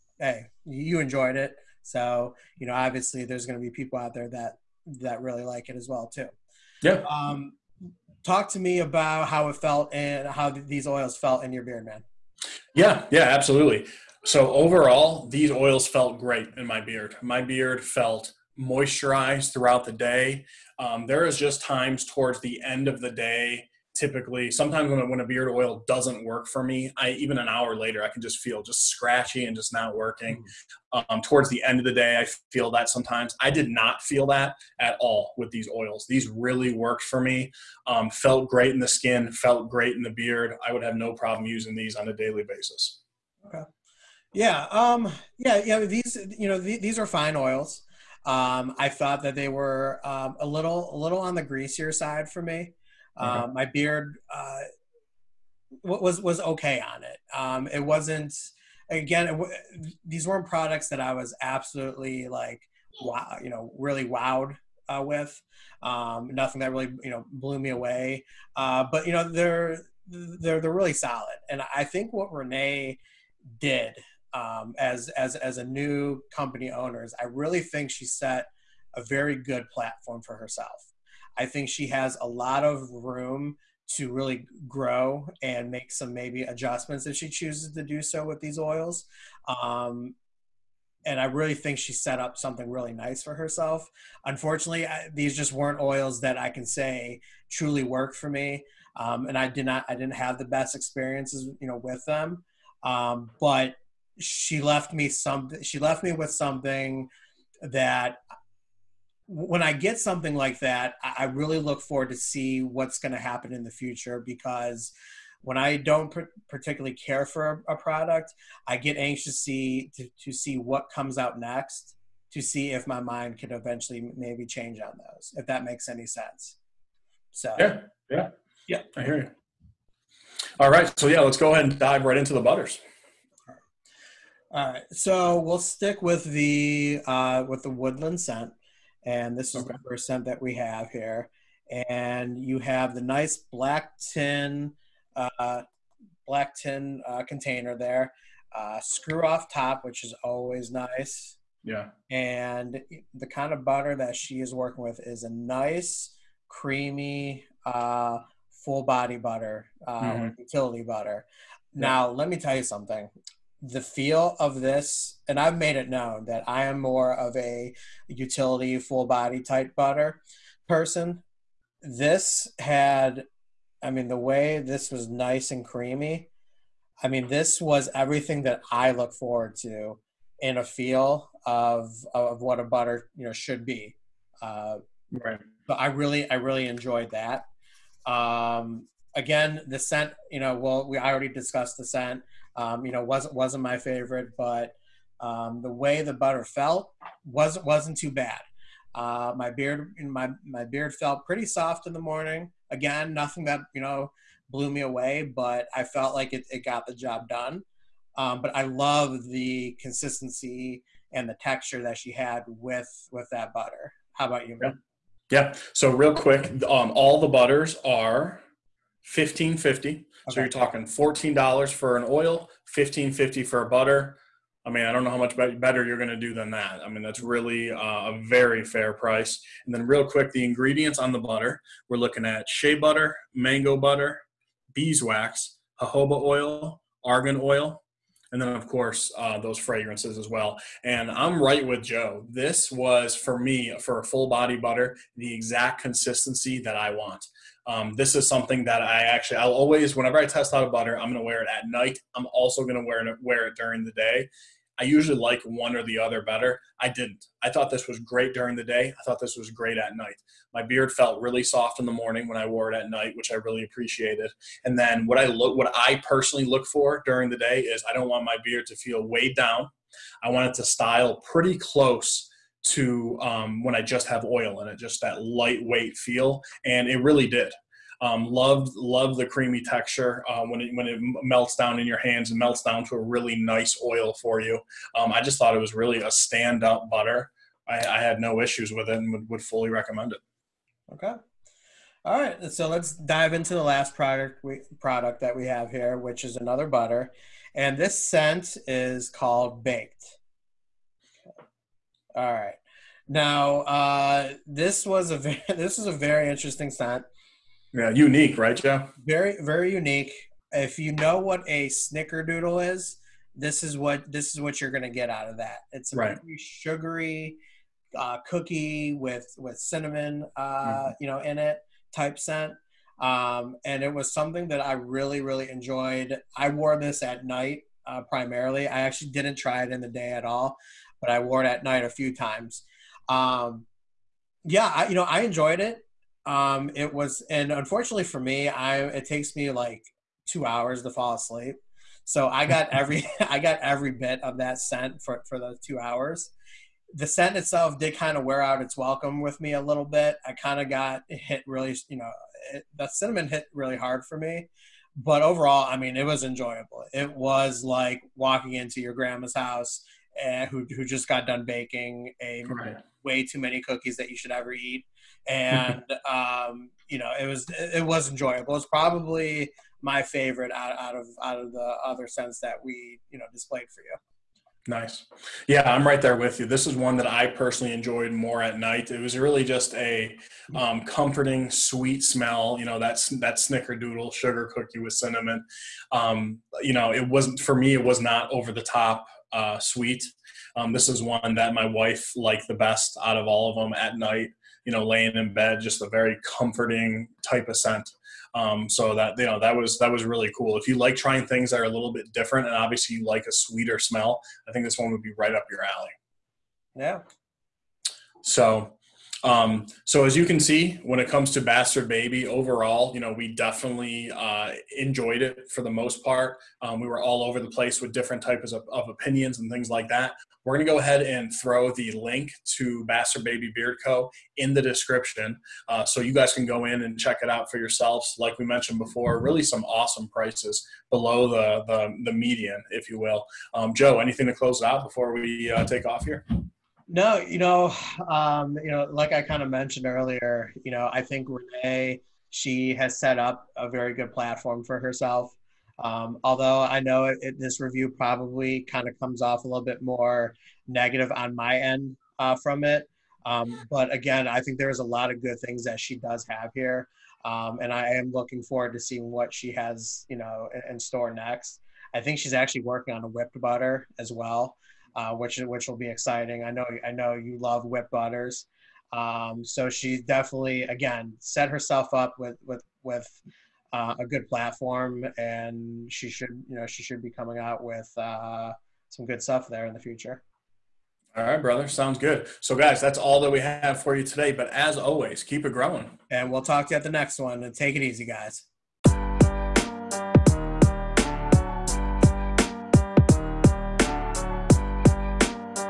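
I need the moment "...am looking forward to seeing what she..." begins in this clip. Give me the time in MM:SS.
07:37.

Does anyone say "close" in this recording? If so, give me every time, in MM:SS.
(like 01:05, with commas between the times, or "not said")
04:31, 07:14.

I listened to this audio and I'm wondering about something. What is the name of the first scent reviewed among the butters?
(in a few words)
Woodland.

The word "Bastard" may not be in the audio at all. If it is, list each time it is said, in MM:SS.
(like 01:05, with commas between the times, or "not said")
06:51, 07:02.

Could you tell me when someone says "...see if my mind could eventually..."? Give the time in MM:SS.
02:02.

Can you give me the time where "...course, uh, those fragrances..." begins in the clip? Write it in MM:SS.
03:58.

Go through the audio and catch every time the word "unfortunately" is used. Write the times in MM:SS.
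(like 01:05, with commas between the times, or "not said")
01:34, 05:37.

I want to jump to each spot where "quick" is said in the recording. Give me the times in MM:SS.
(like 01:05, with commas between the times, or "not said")
03:36, 03:50.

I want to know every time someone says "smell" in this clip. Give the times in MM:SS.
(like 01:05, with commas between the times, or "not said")
06:22, 06:43.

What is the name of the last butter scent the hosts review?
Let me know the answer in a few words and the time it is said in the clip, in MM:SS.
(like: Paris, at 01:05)
Baked, at 04:59.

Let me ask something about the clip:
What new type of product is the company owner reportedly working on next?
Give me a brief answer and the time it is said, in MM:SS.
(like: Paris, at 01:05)
Whipped butter, at 07:43.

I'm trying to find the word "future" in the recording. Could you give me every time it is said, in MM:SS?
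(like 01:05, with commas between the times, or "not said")
01:53, 07:59.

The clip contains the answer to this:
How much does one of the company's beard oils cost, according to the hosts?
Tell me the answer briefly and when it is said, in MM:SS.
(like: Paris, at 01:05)
$14, at 03:40.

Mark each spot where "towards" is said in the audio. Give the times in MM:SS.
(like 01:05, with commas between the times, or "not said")
00:22, 00:31.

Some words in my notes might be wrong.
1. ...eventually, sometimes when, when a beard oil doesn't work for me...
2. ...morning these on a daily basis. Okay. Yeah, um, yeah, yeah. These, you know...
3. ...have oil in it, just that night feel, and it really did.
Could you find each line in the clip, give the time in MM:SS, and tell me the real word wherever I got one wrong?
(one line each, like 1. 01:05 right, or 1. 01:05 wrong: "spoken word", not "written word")
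1. 00:23 wrong: "typically", not "eventually"
2. 00:41 wrong: "using", not "morning"
3. 04:34 wrong: "lightweight", not "night".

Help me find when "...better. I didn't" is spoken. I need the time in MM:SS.
04:16.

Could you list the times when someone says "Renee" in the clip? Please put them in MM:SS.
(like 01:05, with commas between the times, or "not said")
01:12, 07:21.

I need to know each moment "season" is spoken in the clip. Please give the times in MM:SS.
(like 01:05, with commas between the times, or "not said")
not said.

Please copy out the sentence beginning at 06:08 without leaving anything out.
It's probably my favorite out, out of, out of the other scents that we, you know, displayed for you.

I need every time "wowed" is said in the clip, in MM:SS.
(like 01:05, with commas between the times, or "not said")
01:04.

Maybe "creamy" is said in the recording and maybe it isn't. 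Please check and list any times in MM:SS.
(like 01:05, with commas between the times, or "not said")
02:36, 02:55, 04:39.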